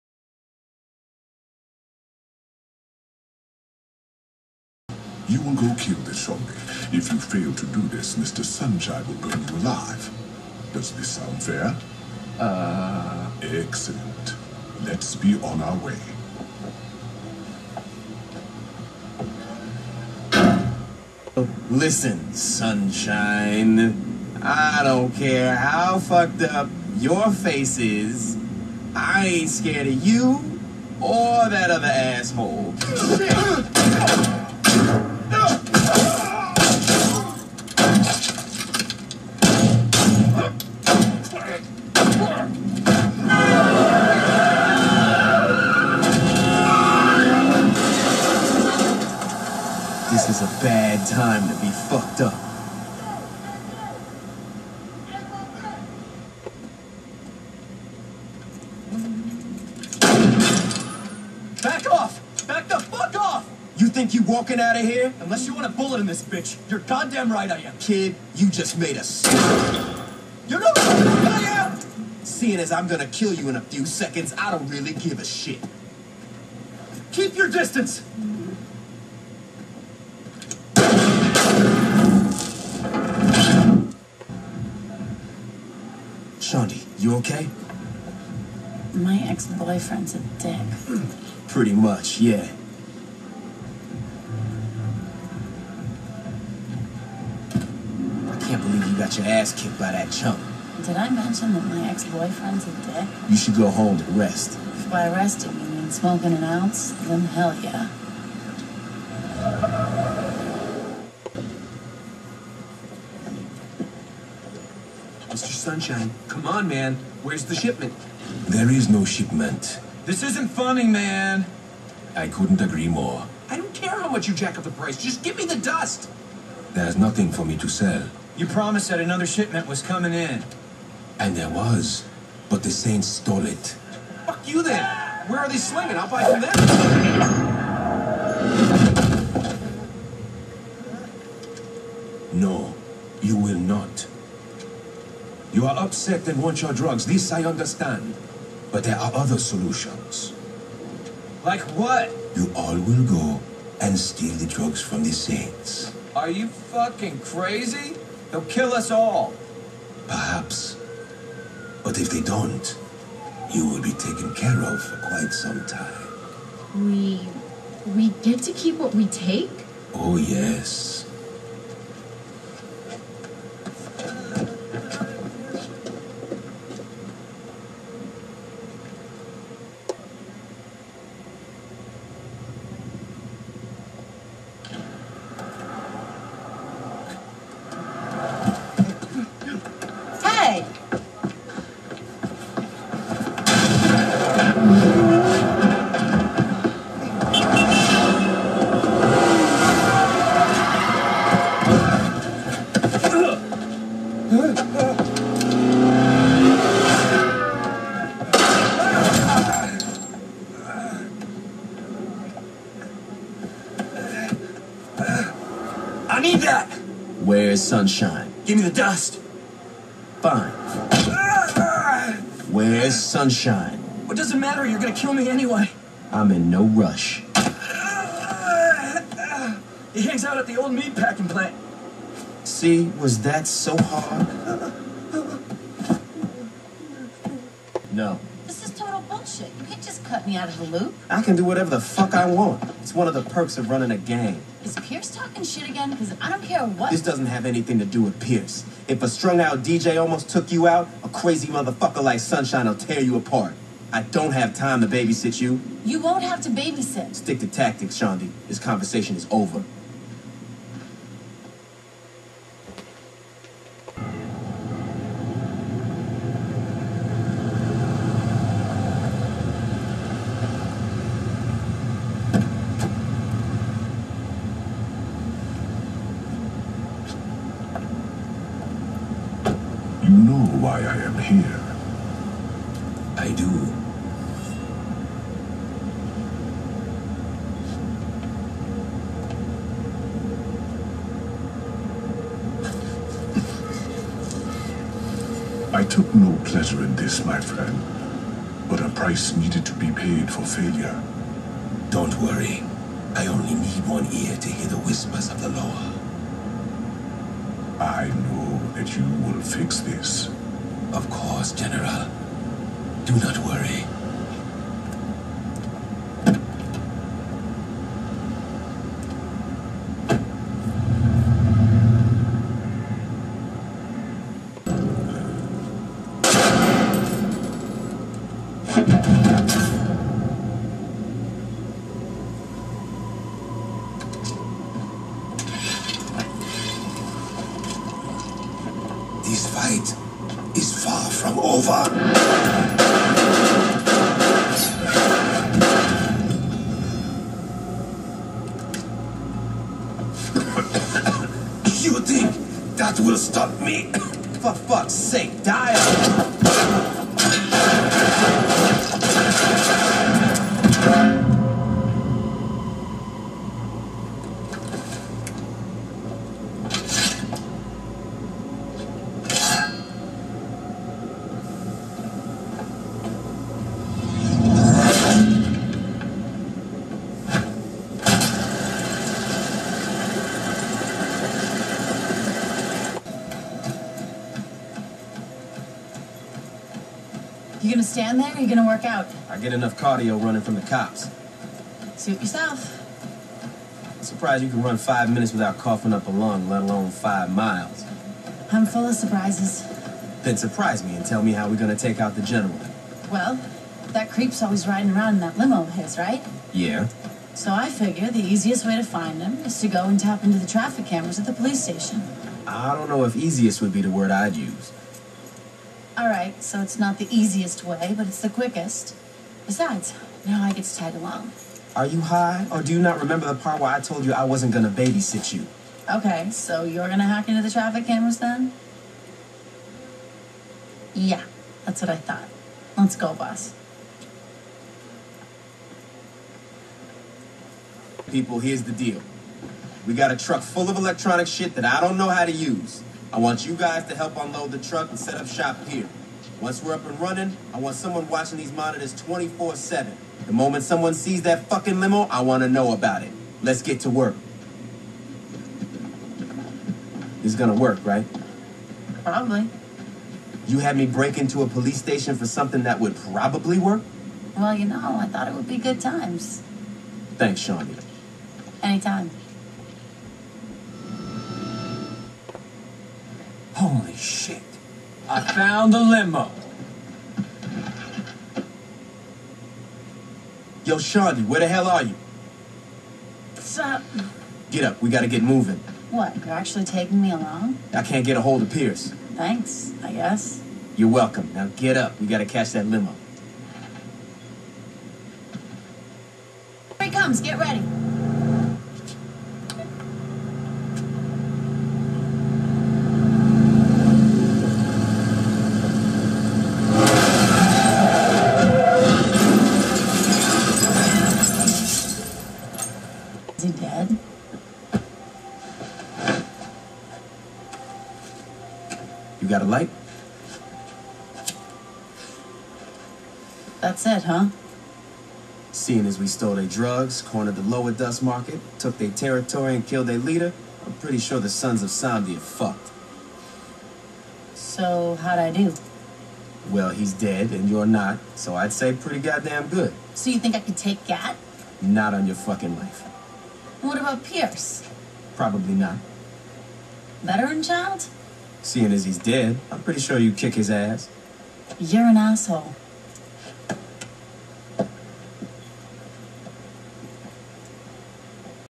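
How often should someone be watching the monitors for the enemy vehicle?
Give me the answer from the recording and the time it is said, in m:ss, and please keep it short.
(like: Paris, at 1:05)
24-7, at 7:29.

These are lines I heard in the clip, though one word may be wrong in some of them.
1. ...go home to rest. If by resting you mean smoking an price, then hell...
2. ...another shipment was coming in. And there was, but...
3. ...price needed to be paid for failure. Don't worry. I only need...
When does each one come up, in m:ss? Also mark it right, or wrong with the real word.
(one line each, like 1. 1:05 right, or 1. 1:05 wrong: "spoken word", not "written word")
1. 1:43 wrong: "ounce", not "price"
2. 2:08 right
3. 4:58 right.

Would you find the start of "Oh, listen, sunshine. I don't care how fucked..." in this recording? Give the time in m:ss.
0:21.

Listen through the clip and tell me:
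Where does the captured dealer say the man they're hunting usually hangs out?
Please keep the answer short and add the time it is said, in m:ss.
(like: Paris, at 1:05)
The old meat packing plant, at 3:50.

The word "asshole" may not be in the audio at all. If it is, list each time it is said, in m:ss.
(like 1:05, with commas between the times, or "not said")
0:31, 9:11.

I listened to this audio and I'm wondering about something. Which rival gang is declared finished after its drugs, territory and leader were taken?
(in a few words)
Sons of Samedi.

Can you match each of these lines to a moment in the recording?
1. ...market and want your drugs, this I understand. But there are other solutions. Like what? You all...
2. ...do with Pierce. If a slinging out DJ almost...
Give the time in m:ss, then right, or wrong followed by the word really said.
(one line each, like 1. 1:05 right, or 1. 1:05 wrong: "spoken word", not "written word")
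1. 2:25 wrong: "upset", not "market"
2. 4:07 wrong: "strung", not "slinging".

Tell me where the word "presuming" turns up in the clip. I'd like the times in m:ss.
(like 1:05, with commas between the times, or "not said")
not said.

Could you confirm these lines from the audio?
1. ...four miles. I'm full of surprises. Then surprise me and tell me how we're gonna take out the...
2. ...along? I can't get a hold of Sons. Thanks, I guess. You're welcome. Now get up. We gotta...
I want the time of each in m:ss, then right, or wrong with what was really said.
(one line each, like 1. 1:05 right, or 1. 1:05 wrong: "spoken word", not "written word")
1. 6:36 wrong: "five", not "four"
2. 8:07 wrong: "Pierce", not "Sons".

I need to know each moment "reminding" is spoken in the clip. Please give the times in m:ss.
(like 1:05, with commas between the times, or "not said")
not said.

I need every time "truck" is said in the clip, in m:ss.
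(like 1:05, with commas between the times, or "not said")
7:20, 7:24.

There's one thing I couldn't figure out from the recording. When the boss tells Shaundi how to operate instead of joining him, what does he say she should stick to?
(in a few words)
Tactics.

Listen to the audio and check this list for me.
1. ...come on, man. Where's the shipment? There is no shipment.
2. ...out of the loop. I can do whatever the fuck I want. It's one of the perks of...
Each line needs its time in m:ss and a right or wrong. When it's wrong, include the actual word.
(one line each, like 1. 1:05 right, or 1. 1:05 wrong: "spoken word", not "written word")
1. 1:56 right
2. 4:00 right.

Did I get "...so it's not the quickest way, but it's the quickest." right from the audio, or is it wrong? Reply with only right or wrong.
wrong.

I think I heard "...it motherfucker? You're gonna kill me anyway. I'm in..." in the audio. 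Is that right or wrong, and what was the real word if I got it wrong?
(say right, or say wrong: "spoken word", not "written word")
wrong: "matter", not "motherfucker".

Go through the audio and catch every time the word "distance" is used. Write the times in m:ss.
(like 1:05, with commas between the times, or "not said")
1:17.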